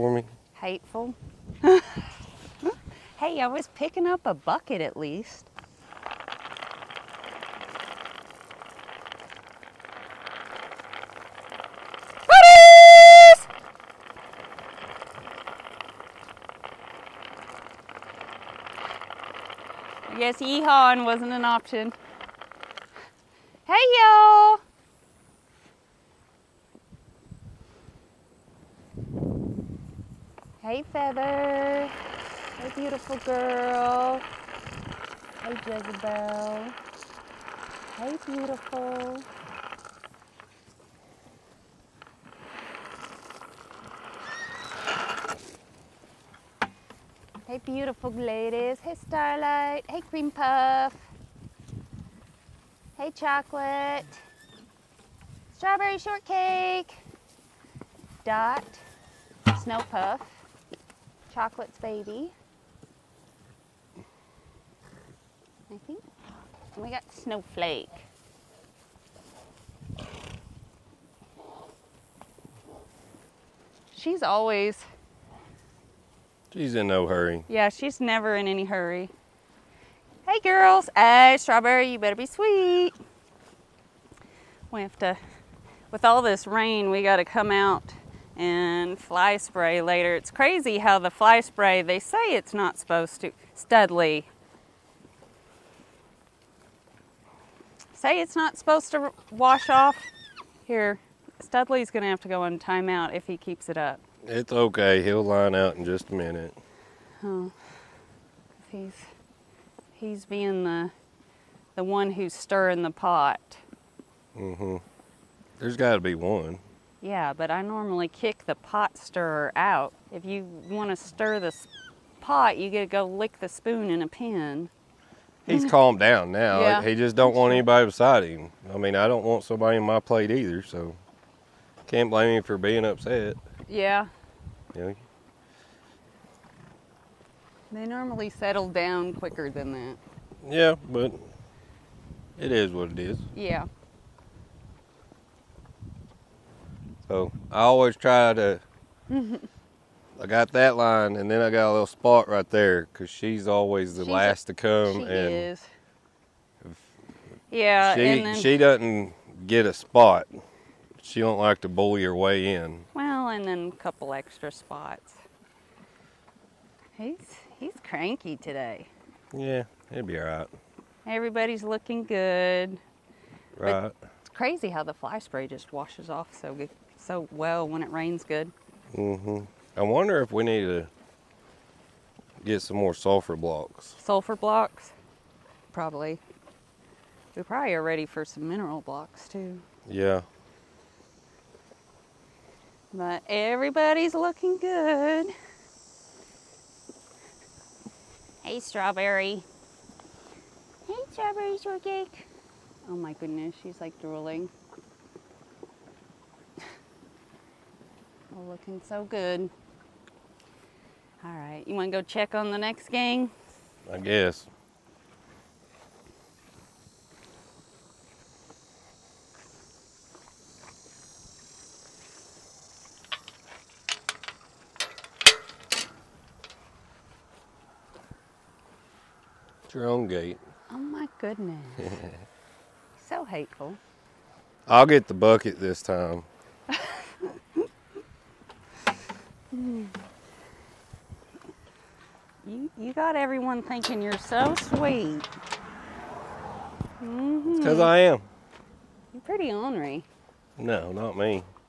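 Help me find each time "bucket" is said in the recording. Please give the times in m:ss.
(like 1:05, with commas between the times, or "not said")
0:04, 3:55.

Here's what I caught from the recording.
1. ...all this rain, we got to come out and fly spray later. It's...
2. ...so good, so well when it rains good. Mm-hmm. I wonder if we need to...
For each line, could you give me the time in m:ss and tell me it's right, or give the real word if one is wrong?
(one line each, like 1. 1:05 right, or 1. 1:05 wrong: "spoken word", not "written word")
1. 1:26 right
2. 2:56 right.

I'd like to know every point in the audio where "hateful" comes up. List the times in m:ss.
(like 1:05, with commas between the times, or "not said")
0:00, 3:53.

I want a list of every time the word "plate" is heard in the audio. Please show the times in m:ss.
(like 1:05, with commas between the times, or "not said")
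2:09.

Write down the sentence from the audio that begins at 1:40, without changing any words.
Here, Studley's going to have to go on timeout if he keeps it up.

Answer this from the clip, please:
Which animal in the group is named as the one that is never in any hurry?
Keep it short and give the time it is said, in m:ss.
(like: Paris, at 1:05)
Snowflake, at 1:07.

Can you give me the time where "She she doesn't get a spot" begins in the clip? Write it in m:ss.
2:38.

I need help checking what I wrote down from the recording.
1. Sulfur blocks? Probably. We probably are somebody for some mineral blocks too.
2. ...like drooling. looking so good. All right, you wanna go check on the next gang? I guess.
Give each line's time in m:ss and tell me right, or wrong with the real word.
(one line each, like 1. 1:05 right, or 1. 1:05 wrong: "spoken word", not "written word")
1. 3:03 wrong: "ready", not "somebody"
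2. 3:23 right.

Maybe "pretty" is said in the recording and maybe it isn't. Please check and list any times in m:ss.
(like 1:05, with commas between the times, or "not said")
4:09.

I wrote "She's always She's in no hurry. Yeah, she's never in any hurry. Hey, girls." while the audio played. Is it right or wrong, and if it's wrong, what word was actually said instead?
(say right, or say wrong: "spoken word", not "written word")
right.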